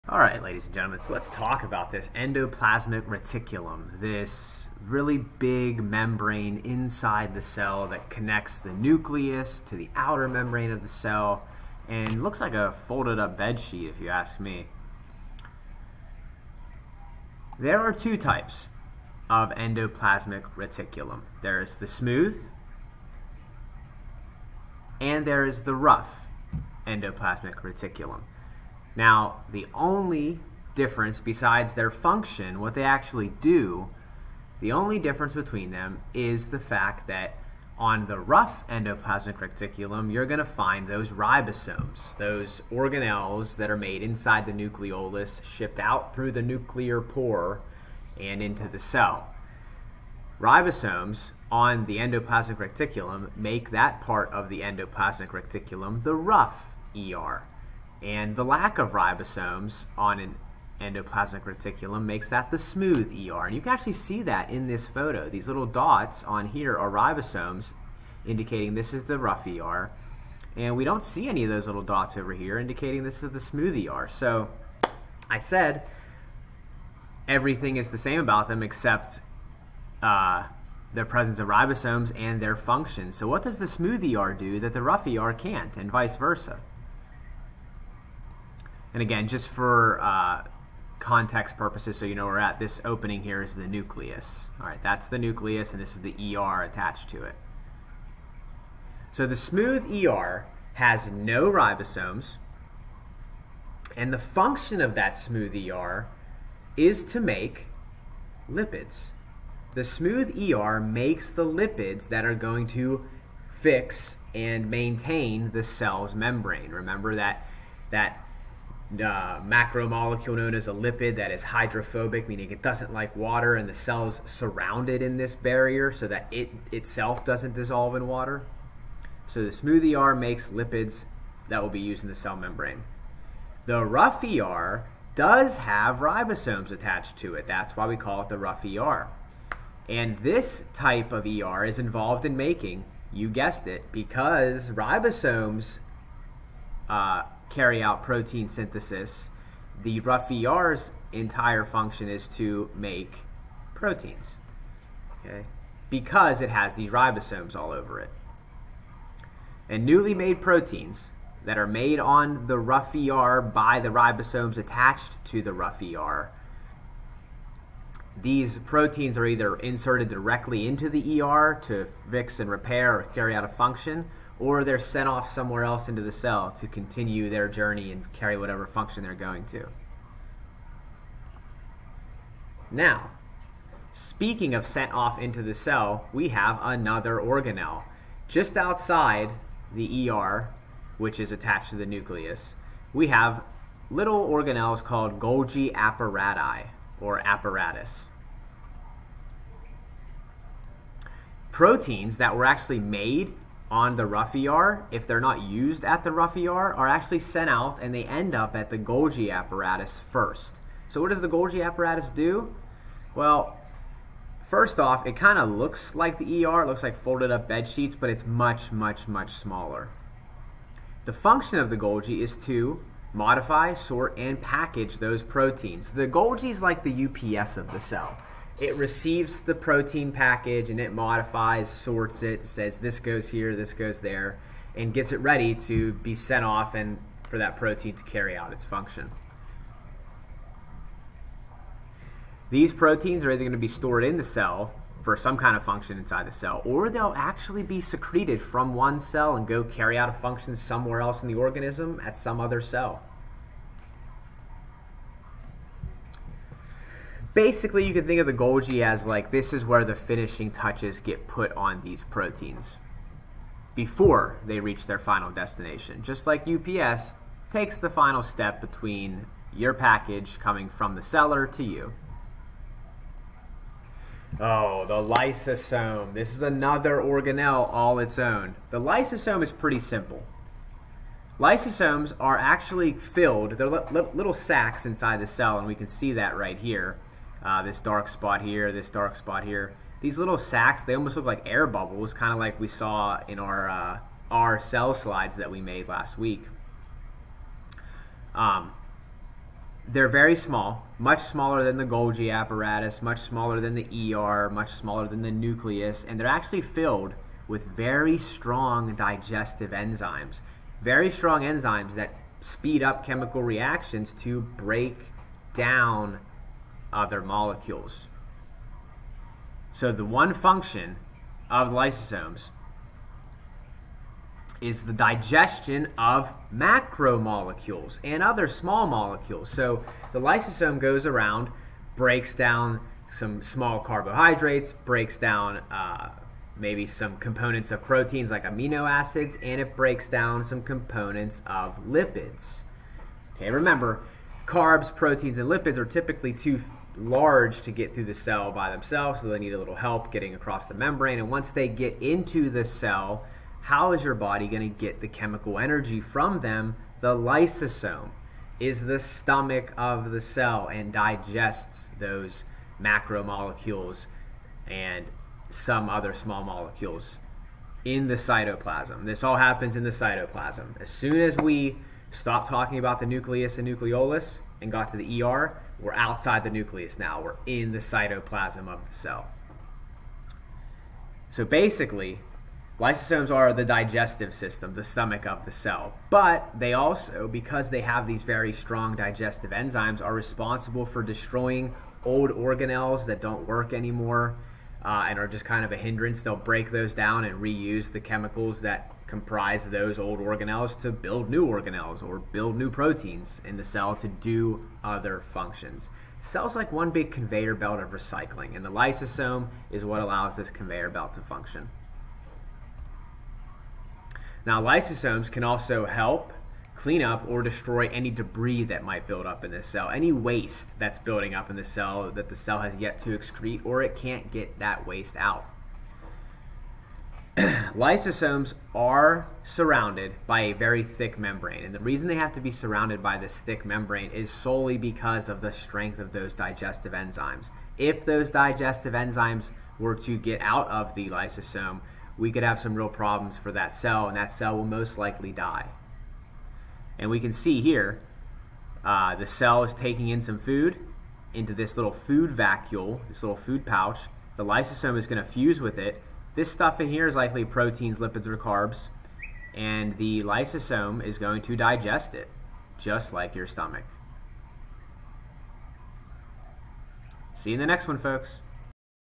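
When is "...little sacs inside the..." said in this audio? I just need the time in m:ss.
4:43.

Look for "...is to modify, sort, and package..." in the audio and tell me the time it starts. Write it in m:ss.
3:42.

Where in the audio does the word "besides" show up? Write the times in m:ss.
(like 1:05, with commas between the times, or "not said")
0:31.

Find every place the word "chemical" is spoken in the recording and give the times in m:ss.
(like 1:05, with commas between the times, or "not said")
5:13, 5:55, 6:37.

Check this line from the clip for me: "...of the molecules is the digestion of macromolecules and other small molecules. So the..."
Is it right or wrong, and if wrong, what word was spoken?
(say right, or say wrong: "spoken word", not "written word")
wrong: "lysosomes", not "molecules".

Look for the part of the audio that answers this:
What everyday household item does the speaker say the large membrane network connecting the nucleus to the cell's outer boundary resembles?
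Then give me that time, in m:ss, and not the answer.
0:12.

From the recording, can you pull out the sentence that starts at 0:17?
There are two types of endoplasmic reticulum.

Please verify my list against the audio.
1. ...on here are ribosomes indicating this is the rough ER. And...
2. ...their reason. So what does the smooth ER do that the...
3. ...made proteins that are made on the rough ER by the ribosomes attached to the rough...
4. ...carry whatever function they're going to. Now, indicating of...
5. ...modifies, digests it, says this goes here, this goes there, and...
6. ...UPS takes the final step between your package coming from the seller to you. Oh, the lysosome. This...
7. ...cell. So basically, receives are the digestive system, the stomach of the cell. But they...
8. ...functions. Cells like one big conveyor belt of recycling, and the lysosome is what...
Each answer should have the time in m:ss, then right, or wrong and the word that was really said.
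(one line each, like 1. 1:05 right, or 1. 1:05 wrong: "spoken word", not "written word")
1. 1:06 right
2. 1:22 wrong: "function", not "reason"
3. 2:40 right
4. 2:58 wrong: "speaking", not "indicating"
5. 3:50 wrong: "sorts", not "digests"
6. 4:26 right
7. 6:18 wrong: "lysosomes", not "receives"
8. 6:45 right.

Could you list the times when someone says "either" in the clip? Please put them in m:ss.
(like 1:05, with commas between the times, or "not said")
2:49, 4:03.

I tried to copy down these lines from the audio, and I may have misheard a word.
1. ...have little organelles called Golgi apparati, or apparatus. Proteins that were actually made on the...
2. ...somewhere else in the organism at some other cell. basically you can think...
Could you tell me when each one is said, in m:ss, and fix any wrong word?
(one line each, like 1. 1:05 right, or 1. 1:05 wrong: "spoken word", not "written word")
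1. 3:13 right
2. 4:10 right.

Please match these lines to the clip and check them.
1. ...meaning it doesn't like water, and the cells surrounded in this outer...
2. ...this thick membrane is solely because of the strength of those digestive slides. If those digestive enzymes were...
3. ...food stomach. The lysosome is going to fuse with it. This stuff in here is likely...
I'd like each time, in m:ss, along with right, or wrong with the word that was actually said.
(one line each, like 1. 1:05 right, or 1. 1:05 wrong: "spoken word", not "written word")
1. 2:02 wrong: "barrier", not "outer"
2. 7:13 wrong: "enzymes", not "slides"
3. 7:33 wrong: "pouch", not "stomach".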